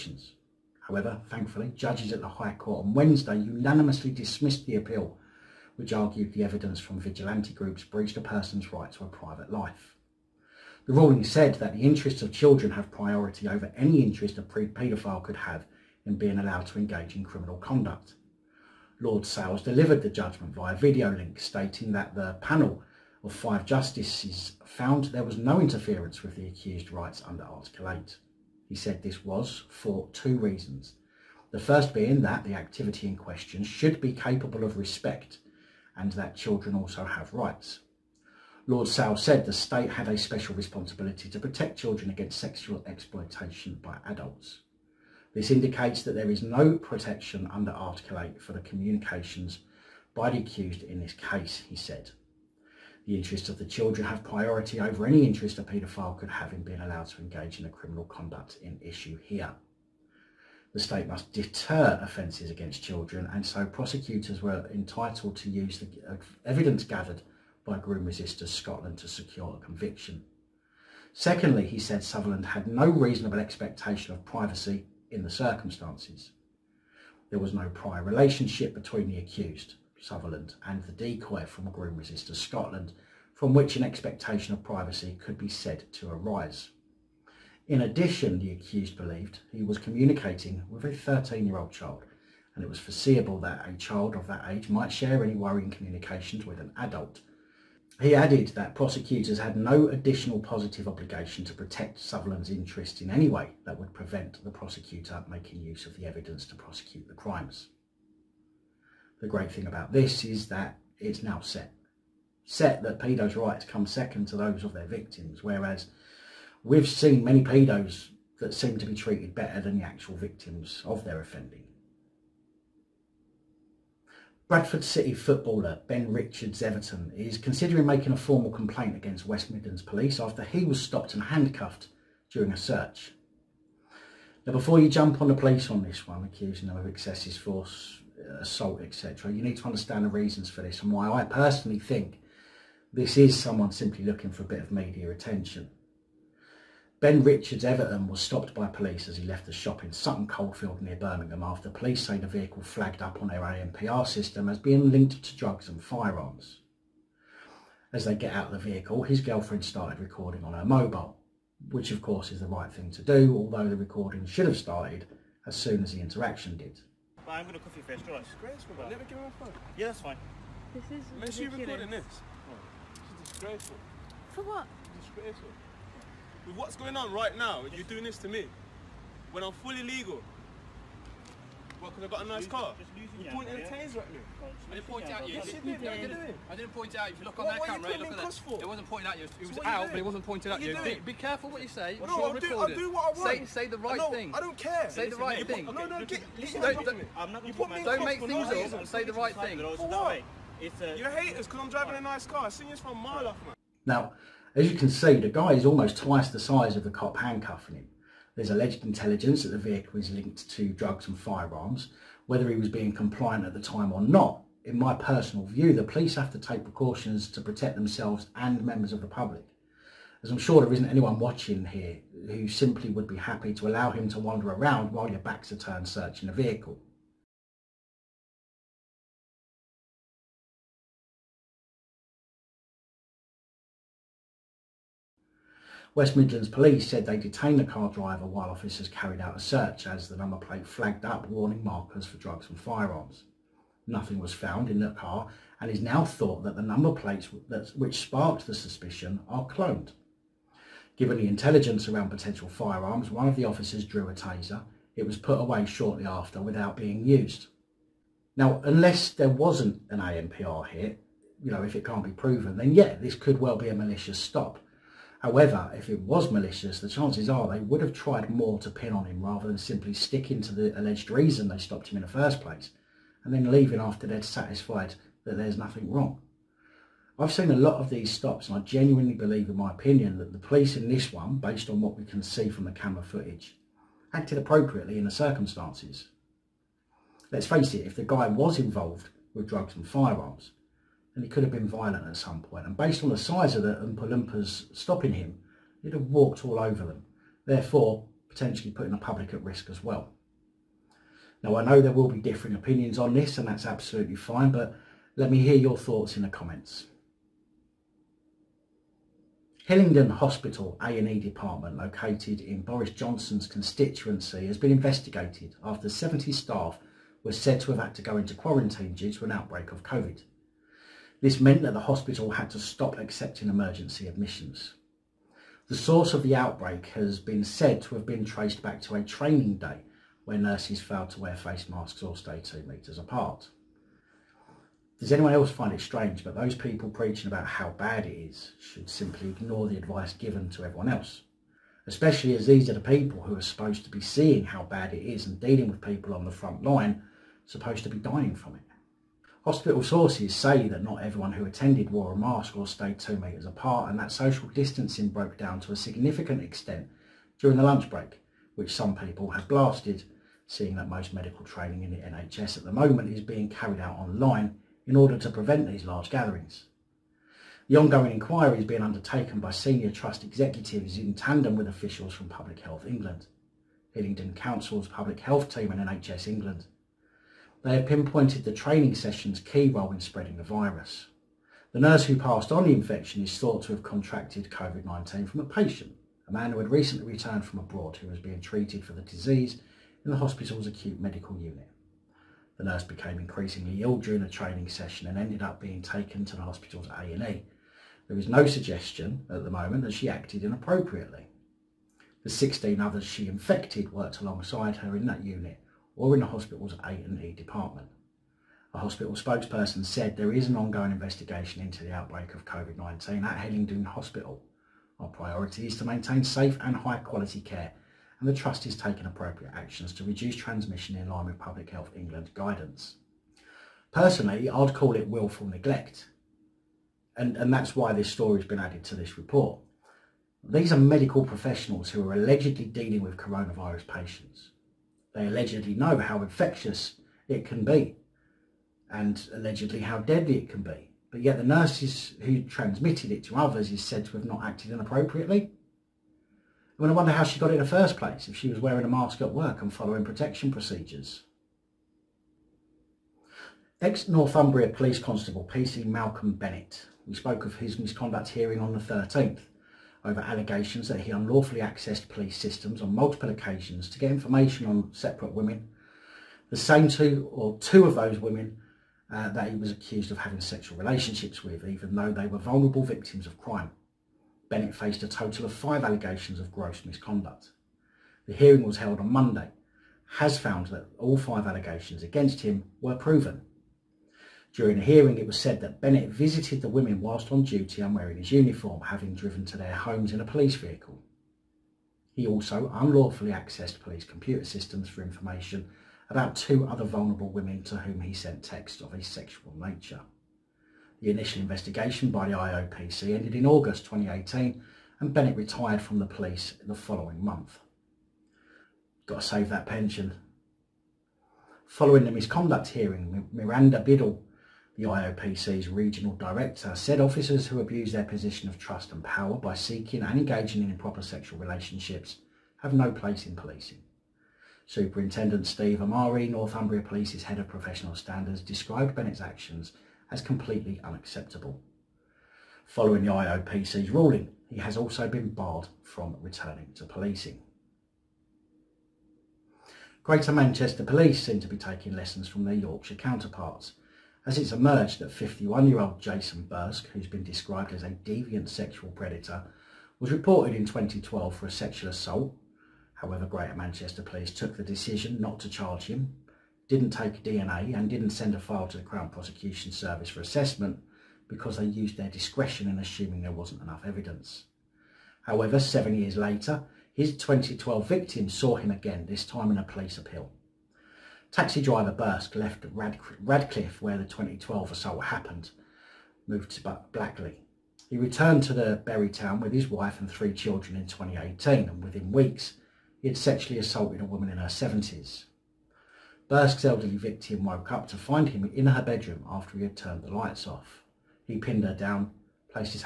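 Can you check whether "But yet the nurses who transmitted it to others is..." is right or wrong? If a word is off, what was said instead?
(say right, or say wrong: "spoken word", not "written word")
right.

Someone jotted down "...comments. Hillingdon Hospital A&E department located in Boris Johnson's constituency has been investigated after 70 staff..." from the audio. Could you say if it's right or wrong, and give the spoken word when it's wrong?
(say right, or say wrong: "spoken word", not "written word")
right.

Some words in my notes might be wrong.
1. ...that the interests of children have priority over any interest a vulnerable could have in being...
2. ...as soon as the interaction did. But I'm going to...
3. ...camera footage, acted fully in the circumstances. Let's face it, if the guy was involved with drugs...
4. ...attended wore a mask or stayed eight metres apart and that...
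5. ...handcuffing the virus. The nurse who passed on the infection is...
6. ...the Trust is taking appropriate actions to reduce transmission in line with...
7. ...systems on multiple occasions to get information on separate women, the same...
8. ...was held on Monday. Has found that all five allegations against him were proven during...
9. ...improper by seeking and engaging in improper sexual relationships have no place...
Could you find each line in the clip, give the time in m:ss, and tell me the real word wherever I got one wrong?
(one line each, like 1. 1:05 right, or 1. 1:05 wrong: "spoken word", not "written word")
1. 0:11 wrong: "paedophile", not "vulnerable"
2. 2:45 right
3. 4:42 wrong: "appropriately", not "fully"
4. 5:51 wrong: "two", not "eight"
5. 6:19 wrong: "spreading", not "handcuffing"
6. 6:58 right
7. 7:42 right
8. 7:58 right
9. 8:39 wrong: "power", not "improper".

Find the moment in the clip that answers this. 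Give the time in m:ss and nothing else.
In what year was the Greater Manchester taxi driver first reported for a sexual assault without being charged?
9:10.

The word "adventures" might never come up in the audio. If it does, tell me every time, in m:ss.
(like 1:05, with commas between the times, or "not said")
not said.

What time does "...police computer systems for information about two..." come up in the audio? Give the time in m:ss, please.
8:13.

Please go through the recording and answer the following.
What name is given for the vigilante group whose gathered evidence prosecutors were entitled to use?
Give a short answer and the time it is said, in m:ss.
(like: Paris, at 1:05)
Groom Resisters Scotland, at 1:07.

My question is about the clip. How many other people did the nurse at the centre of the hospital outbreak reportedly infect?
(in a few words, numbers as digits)
16.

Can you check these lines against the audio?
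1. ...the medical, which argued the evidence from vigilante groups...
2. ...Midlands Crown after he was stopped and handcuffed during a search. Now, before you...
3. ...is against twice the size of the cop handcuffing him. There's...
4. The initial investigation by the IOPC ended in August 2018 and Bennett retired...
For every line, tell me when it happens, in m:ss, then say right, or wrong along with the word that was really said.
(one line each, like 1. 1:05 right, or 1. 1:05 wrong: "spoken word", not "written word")
1. 0:04 wrong: "appeal", not "medical"
2. 2:09 wrong: "Police", not "Crown"
3. 3:25 wrong: "almost", not "against"
4. 8:20 right.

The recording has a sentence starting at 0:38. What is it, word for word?
Lord Sales said the state had a special responsibility to protect children against sexual exploitation by adults.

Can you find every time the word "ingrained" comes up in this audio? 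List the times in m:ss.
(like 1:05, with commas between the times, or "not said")
not said.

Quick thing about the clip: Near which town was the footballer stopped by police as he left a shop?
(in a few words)
Sutton Coldfield.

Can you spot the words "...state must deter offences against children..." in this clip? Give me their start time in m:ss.
1:00.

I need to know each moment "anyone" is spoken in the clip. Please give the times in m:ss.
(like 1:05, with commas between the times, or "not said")
3:40, 5:35.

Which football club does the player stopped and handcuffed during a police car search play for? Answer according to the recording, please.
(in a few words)
Bradford City.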